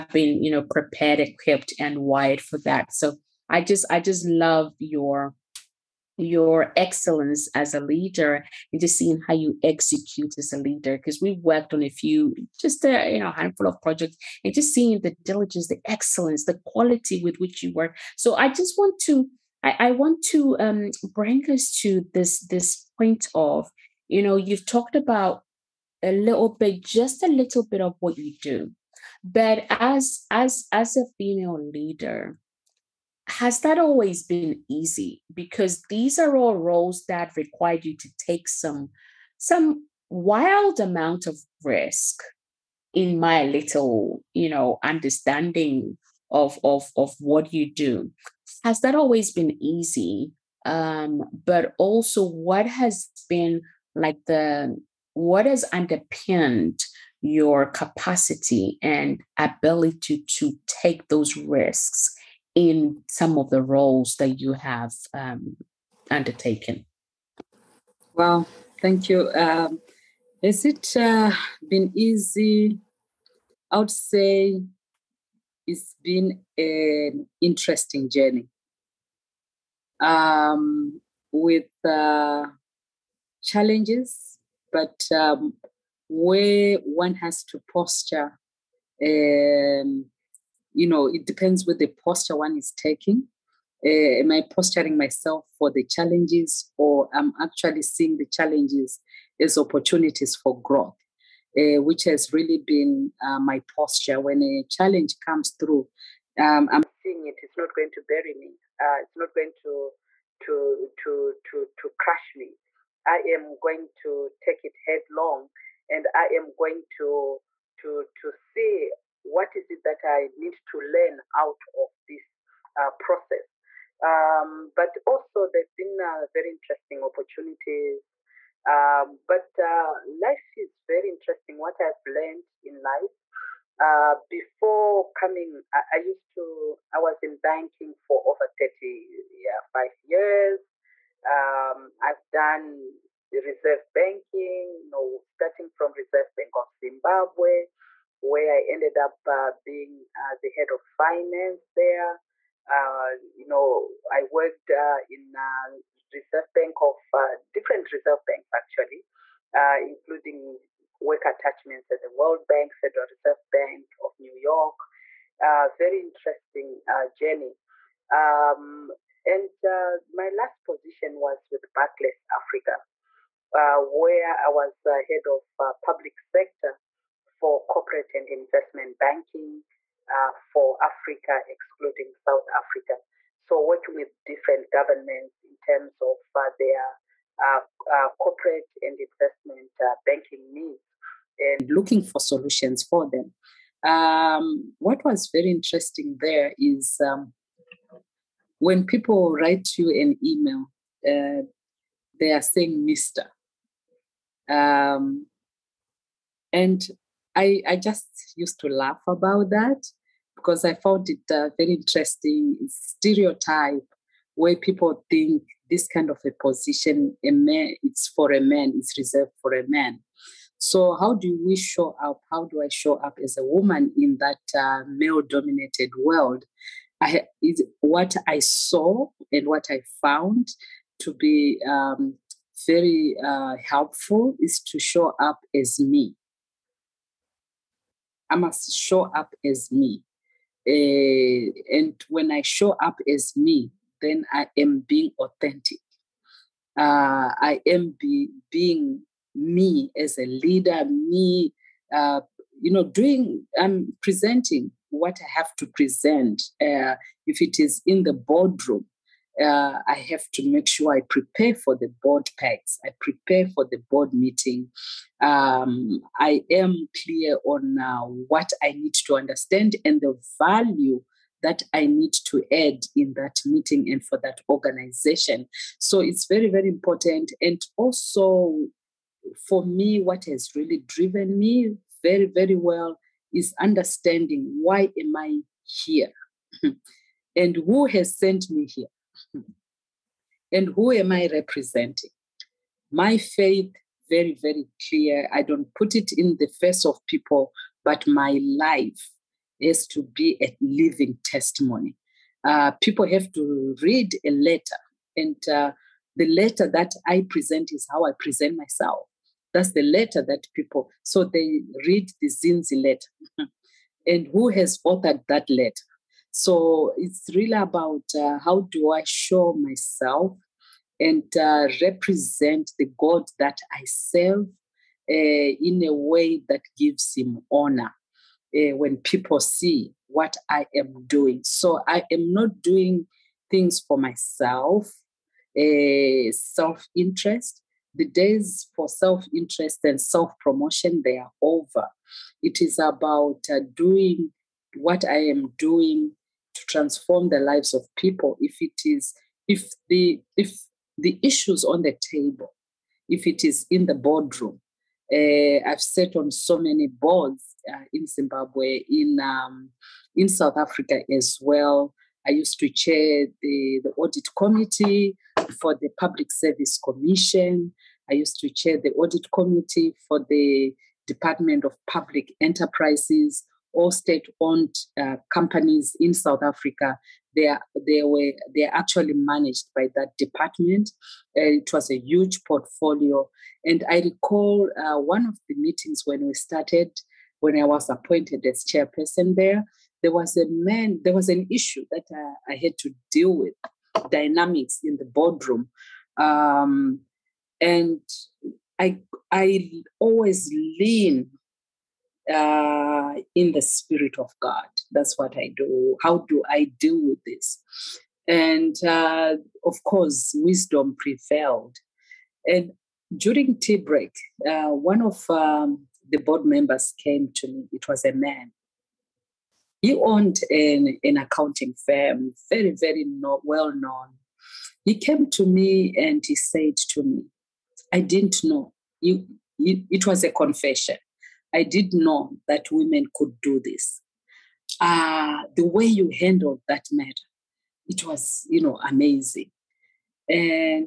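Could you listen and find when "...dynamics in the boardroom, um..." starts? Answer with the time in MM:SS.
06:34.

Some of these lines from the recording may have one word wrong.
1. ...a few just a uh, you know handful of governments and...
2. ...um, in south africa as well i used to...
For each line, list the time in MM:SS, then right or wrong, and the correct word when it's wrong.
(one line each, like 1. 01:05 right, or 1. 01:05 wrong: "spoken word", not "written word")
1. 00:11 wrong: "projects", not "governments"
2. 05:59 right.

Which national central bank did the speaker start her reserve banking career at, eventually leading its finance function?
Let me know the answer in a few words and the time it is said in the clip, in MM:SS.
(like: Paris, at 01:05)
Reserve Bank of Zimbabwe, at 02:25.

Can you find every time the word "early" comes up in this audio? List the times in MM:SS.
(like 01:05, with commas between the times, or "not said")
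not said.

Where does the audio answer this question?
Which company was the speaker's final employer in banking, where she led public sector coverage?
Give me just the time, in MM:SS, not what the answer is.
02:51.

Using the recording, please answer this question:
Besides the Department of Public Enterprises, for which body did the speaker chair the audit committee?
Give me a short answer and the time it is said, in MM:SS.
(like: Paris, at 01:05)
Public Service Commission, at 06:05.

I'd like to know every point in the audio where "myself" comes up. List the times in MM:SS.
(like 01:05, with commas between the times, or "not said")
01:34, 05:08, 05:19, 05:33.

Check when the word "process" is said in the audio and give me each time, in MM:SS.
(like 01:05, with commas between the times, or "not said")
02:02.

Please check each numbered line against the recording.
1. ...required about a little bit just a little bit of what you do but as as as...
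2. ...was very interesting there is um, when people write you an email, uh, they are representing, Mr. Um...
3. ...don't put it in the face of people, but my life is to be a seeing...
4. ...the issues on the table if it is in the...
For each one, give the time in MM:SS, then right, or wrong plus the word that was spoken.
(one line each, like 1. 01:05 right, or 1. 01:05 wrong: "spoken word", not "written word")
1. 00:24 wrong: "talked", not "required"
2. 03:15 wrong: "saying", not "representing"
3. 04:55 wrong: "living", not "seeing"
4. 05:50 right.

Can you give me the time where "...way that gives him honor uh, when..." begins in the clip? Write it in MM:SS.
05:25.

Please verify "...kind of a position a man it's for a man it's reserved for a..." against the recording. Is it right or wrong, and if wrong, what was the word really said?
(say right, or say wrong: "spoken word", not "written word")
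right.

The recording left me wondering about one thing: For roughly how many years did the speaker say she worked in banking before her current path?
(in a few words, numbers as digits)
35 years.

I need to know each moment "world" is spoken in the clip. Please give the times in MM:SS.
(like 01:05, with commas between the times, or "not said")
02:42, 03:46.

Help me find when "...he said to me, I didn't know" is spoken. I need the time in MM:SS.
07:06.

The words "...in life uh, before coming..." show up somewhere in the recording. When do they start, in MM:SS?
02:12.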